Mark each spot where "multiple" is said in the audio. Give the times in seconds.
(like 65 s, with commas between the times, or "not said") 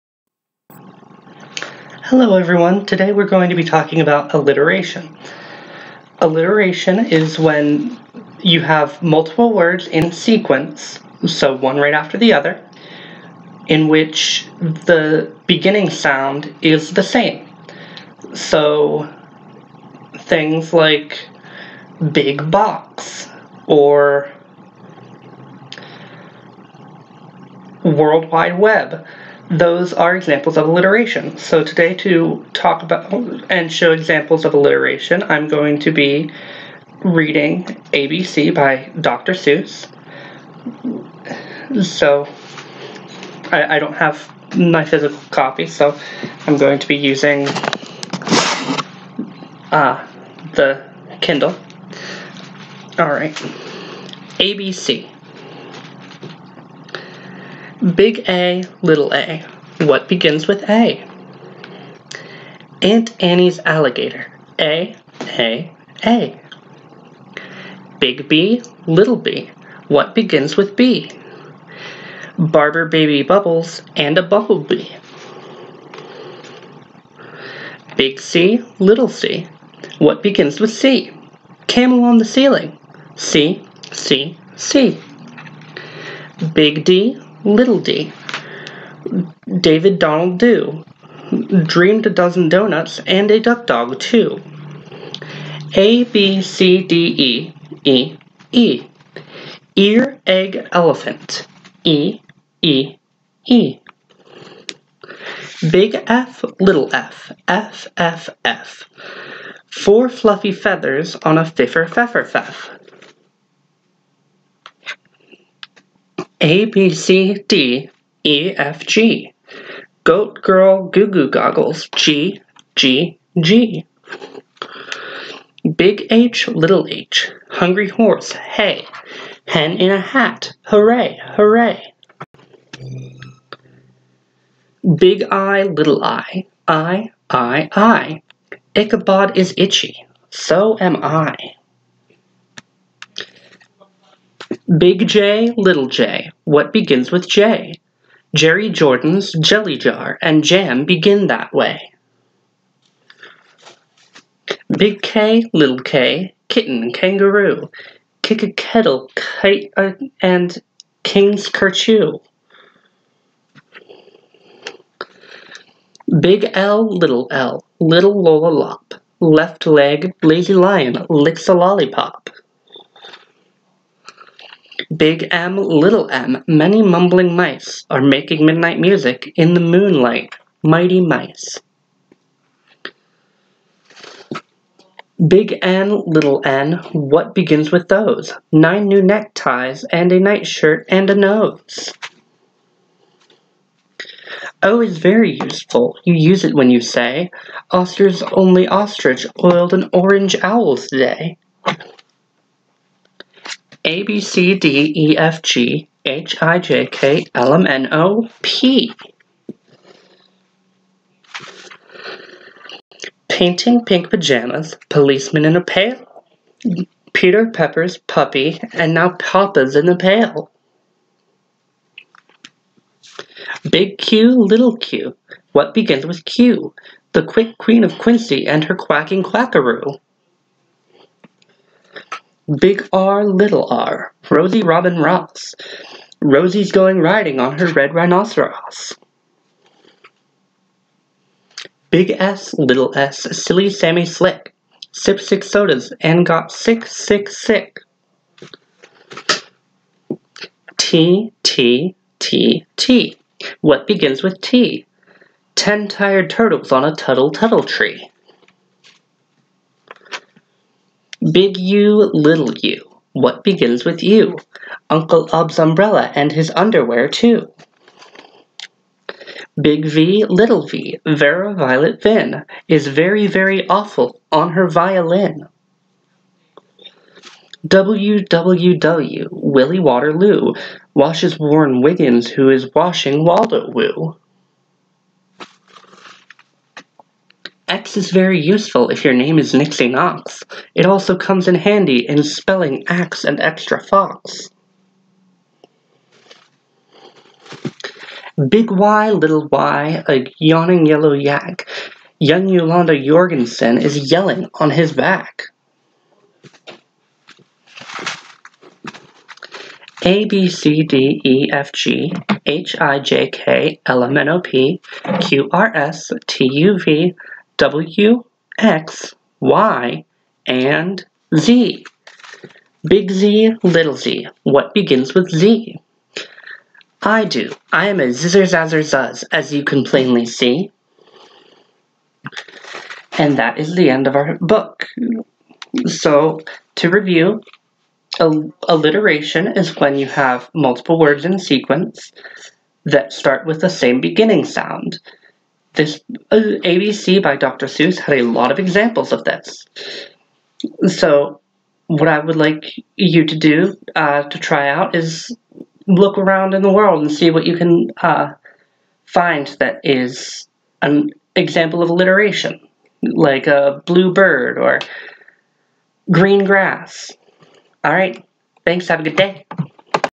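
9 s, 340 s.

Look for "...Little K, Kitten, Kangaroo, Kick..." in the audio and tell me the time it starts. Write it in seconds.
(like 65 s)
155 s.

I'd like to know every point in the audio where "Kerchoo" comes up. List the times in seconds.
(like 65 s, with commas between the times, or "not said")
161 s.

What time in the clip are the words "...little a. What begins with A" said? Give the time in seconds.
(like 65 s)
58 s.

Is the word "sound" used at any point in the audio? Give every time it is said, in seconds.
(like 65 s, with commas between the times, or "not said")
15 s, 344 s.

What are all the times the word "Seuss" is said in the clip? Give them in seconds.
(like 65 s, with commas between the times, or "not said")
39 s, 347 s.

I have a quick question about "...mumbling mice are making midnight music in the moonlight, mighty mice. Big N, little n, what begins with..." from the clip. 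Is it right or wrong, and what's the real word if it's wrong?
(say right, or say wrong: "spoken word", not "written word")
right.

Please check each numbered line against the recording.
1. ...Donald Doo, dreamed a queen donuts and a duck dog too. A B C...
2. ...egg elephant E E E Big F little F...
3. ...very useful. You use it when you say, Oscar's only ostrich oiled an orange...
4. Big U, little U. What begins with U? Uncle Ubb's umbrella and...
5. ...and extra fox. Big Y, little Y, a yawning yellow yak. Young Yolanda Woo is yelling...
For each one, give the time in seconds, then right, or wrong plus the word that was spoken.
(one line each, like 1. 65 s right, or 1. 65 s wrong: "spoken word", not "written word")
1. 89 s wrong: "dozen", not "queen"
2. 100 s right
3. 194 s right
4. 261 s right
5. 293 s wrong: "Yorgenson", not "Woo".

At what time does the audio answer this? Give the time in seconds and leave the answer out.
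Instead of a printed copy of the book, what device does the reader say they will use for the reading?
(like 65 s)
50 s.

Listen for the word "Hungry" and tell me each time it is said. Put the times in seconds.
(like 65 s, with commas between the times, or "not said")
127 s.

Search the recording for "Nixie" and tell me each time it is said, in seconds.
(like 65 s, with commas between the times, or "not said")
289 s.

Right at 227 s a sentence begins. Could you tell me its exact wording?
The quick queen of Quincy and her quacking quackaroo.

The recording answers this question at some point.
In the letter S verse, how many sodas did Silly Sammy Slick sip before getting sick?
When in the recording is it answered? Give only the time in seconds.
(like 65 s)
245 s.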